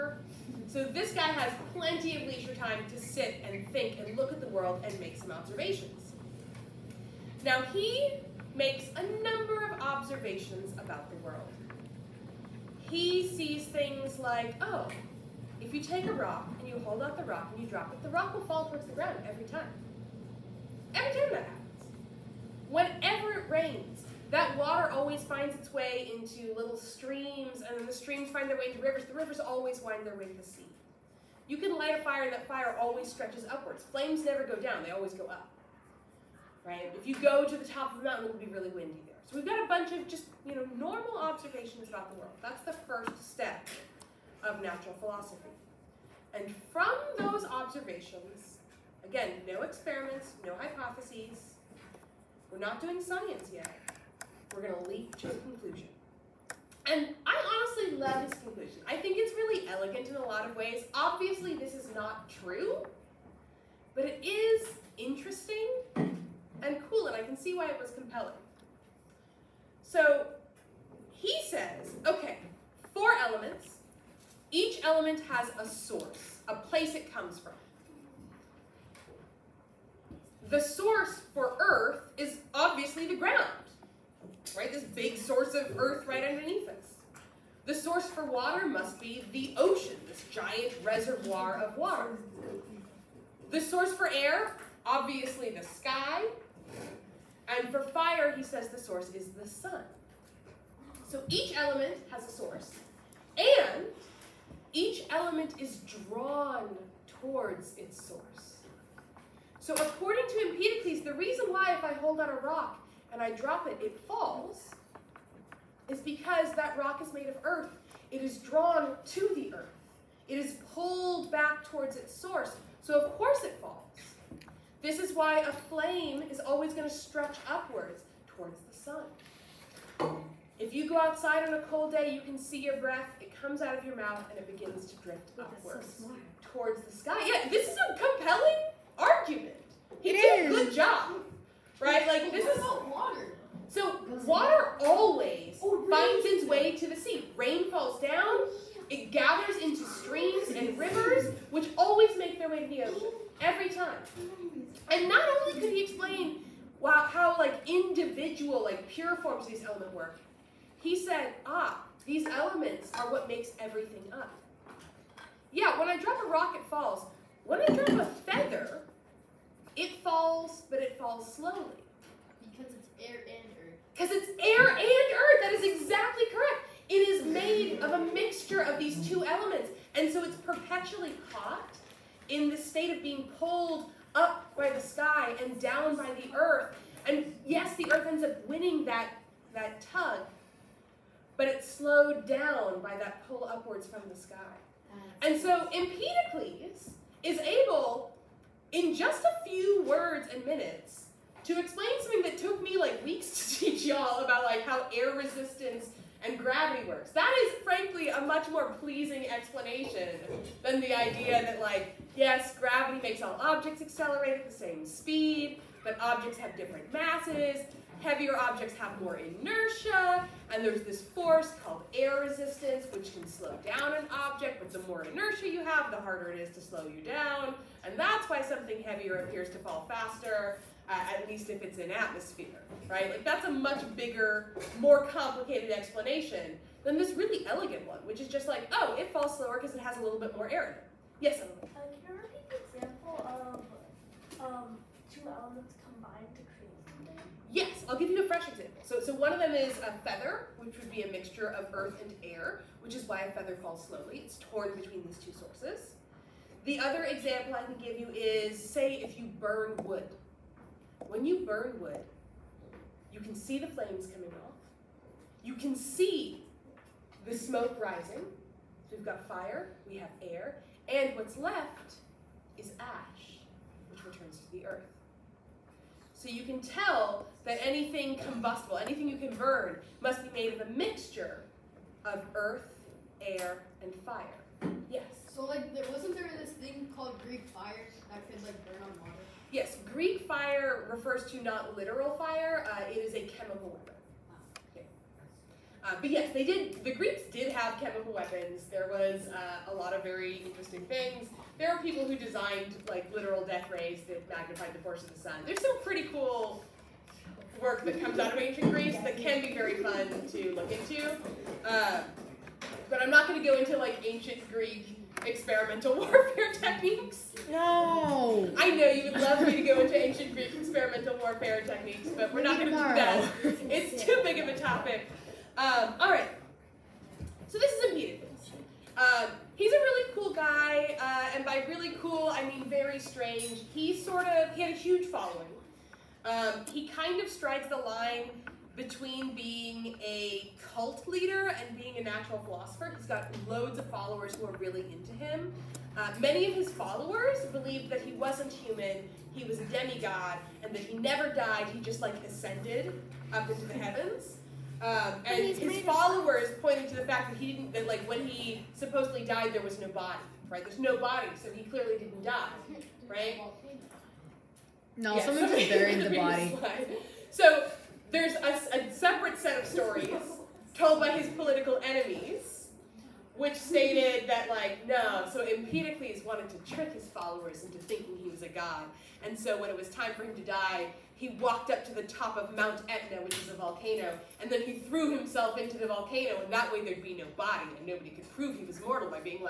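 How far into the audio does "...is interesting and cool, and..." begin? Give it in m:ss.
1:04.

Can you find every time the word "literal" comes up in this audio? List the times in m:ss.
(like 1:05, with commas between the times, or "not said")
4:51, 5:03.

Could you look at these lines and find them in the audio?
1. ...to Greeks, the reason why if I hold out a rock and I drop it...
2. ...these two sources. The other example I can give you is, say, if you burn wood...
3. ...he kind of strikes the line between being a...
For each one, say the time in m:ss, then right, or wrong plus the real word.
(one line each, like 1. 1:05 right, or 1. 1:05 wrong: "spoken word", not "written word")
1. 1:50 wrong: "Empedocles", not "Greeks"
2. 4:15 right
3. 5:36 right.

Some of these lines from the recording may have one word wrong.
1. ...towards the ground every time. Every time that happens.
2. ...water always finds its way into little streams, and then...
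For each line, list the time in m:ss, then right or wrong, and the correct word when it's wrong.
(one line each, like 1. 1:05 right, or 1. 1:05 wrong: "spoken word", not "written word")
1. 0:18 right
2. 0:24 right.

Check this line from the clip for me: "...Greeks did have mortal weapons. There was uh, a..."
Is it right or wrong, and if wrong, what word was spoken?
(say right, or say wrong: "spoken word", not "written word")
wrong: "chemical", not "mortal".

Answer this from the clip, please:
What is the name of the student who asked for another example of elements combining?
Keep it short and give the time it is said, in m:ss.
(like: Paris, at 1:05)
Emily, at 4:01.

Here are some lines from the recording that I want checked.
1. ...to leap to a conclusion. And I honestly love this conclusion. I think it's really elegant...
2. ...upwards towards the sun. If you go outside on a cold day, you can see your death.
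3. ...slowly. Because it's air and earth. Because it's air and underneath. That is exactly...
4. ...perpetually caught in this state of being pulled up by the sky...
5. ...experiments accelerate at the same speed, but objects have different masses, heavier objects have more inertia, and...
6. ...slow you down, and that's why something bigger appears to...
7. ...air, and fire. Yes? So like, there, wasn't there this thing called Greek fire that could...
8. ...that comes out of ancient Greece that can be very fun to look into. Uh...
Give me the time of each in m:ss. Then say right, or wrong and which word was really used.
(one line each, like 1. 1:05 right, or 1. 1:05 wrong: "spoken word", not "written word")
1. 0:54 right
2. 2:07 wrong: "breath", not "death"
3. 2:51 wrong: "earth", not "underneath"
4. 3:00 right
5. 3:33 wrong: "objects", not "experiments"
6. 3:46 wrong: "heavier", not "bigger"
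7. 4:43 right
8. 5:07 right.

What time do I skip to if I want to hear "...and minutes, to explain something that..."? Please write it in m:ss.
3:20.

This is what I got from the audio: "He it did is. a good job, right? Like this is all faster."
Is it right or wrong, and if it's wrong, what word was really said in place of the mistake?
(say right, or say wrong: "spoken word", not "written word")
wrong: "water", not "faster".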